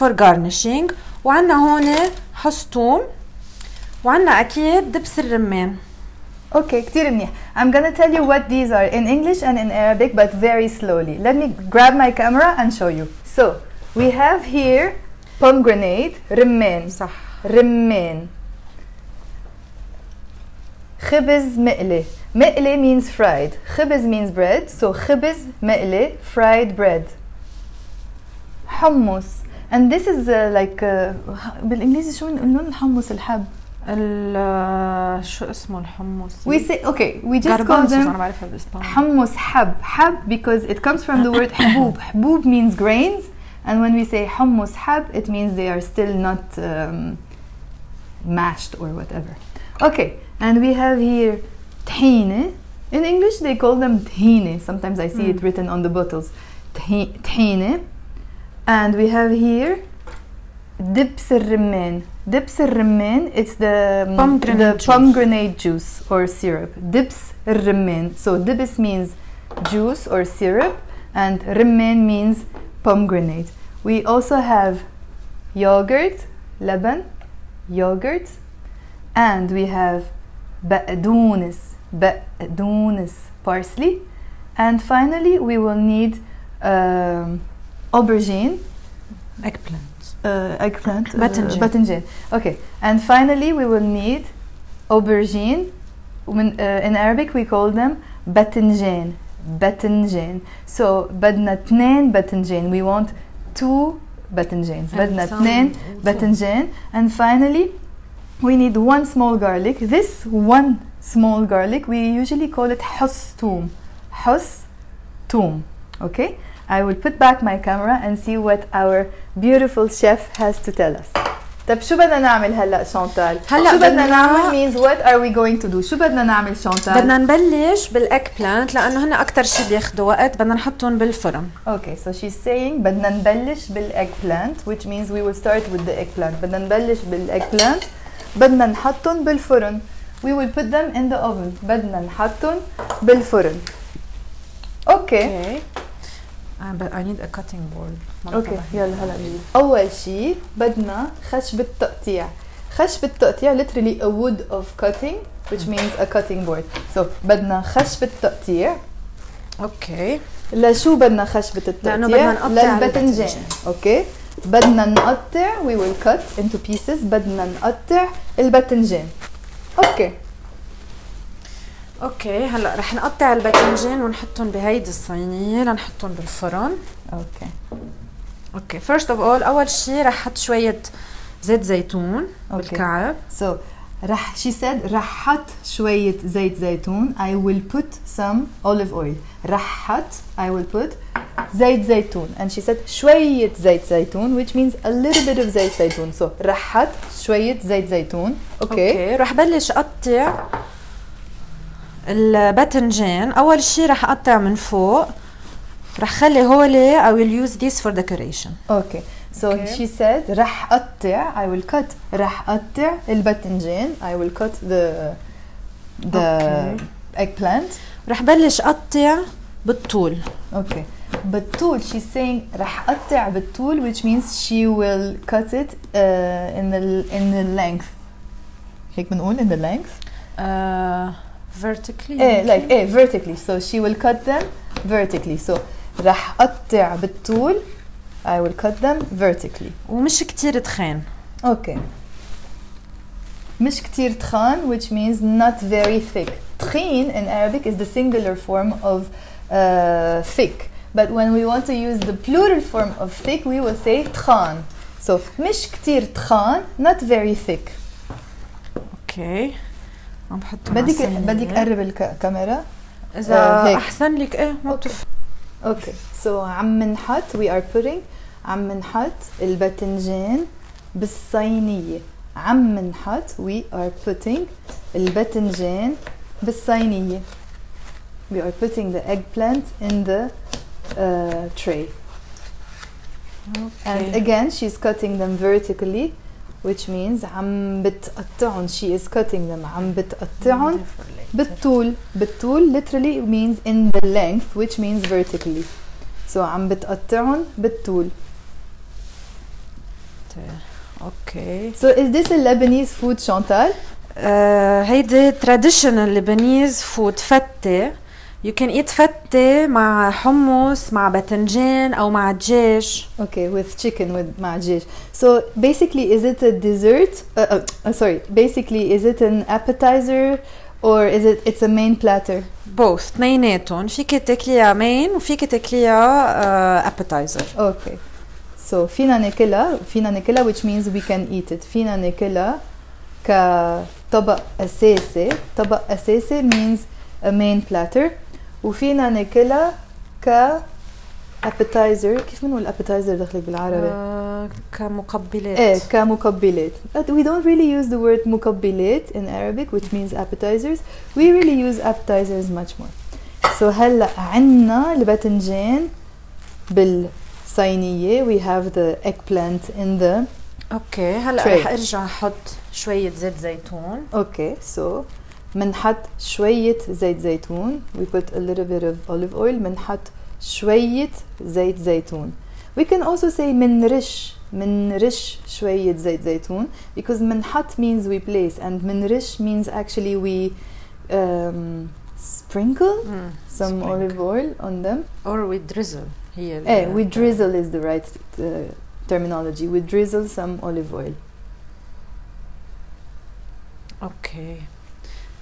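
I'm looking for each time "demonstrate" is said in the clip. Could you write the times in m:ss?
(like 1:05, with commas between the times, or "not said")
not said.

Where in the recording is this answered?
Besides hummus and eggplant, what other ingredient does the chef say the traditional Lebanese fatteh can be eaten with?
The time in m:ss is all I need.
5:13.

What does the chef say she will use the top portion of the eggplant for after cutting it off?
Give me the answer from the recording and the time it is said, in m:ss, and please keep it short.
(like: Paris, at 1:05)
decoration, at 3:27.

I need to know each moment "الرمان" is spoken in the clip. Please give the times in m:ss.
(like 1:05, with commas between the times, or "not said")
0:05, 1:01, 1:07.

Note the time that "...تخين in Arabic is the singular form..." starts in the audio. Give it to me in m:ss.
4:06.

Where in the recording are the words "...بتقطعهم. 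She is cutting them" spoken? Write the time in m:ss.
4:47.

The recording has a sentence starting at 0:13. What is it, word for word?
So, we have here pomegranate, رمان صح رمان خبز مقلي Me'le means fried.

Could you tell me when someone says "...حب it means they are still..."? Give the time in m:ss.
0:44.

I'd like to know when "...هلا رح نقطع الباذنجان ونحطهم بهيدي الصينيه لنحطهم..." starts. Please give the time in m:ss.
2:52.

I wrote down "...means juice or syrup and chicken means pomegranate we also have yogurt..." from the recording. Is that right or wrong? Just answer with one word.
wrong.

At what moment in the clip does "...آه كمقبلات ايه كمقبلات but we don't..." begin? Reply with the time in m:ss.
5:43.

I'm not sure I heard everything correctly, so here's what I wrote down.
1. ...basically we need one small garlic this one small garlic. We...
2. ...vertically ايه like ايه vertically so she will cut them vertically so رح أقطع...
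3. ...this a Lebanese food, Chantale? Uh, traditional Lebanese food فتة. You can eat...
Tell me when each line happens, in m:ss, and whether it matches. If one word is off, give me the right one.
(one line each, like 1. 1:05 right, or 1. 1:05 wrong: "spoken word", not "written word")
1. 1:47 wrong: "finally", not "basically"
2. 3:51 right
3. 5:02 right.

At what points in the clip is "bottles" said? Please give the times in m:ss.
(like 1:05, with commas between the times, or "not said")
0:55.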